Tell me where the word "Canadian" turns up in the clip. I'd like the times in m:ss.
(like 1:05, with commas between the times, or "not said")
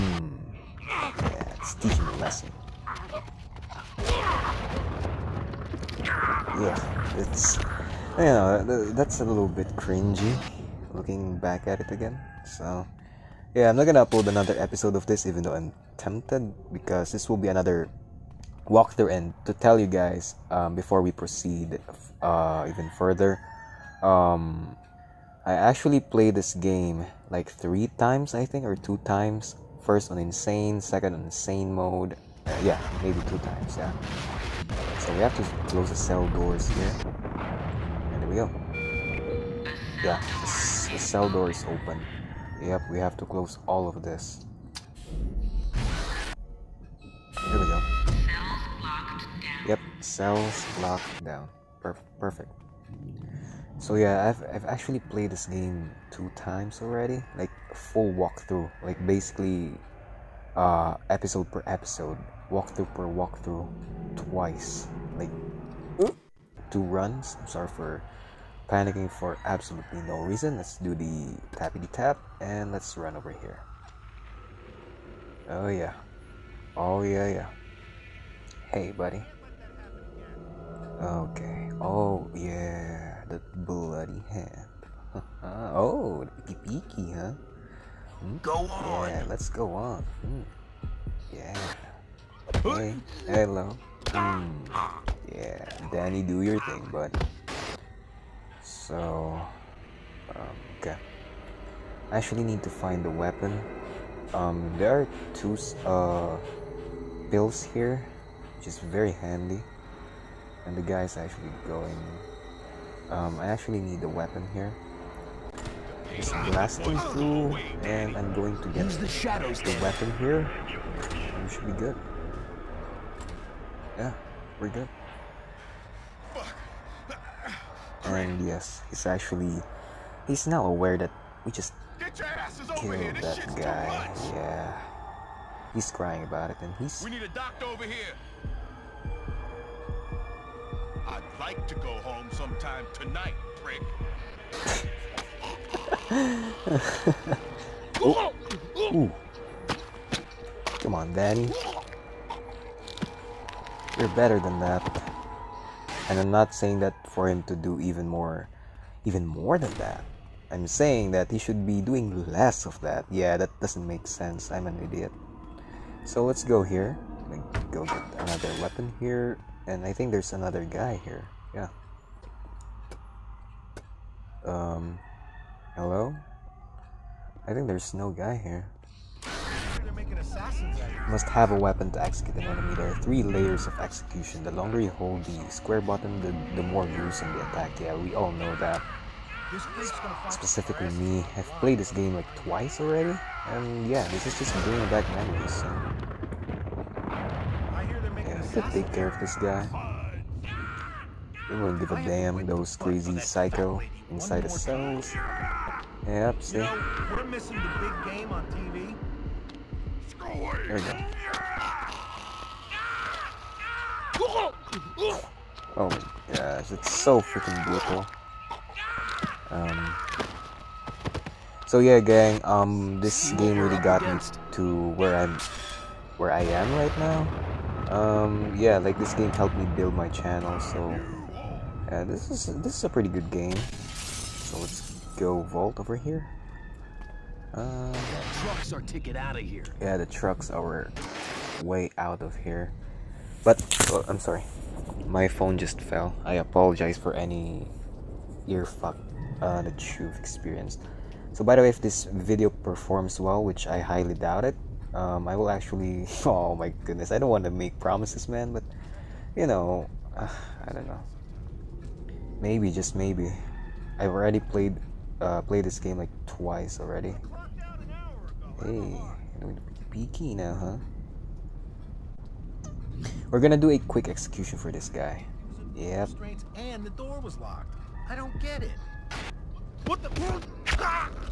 not said.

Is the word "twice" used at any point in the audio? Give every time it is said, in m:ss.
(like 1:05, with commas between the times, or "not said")
1:04, 3:12, 4:26.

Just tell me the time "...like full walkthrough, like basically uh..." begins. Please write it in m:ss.
0:57.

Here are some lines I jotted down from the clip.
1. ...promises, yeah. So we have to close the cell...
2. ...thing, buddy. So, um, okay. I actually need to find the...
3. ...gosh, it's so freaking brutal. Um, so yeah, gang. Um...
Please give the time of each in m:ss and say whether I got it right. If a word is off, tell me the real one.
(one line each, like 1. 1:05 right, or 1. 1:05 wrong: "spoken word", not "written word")
1. 0:33 wrong: "times", not "promises"
2. 1:36 right
3. 3:36 right.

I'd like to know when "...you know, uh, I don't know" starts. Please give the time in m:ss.
4:19.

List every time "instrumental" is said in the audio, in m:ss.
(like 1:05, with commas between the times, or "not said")
not said.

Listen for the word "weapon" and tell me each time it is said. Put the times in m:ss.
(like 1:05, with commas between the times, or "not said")
1:43, 1:54, 1:59, 2:48, 3:01.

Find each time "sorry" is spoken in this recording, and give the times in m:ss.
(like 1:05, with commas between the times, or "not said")
1:07, 4:04.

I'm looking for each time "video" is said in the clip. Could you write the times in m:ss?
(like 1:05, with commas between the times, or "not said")
4:12.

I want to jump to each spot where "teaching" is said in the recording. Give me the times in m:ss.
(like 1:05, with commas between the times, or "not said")
0:01.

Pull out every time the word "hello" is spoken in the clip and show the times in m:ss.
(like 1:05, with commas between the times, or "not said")
1:33, 2:55.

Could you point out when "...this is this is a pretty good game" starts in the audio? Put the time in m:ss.
3:52.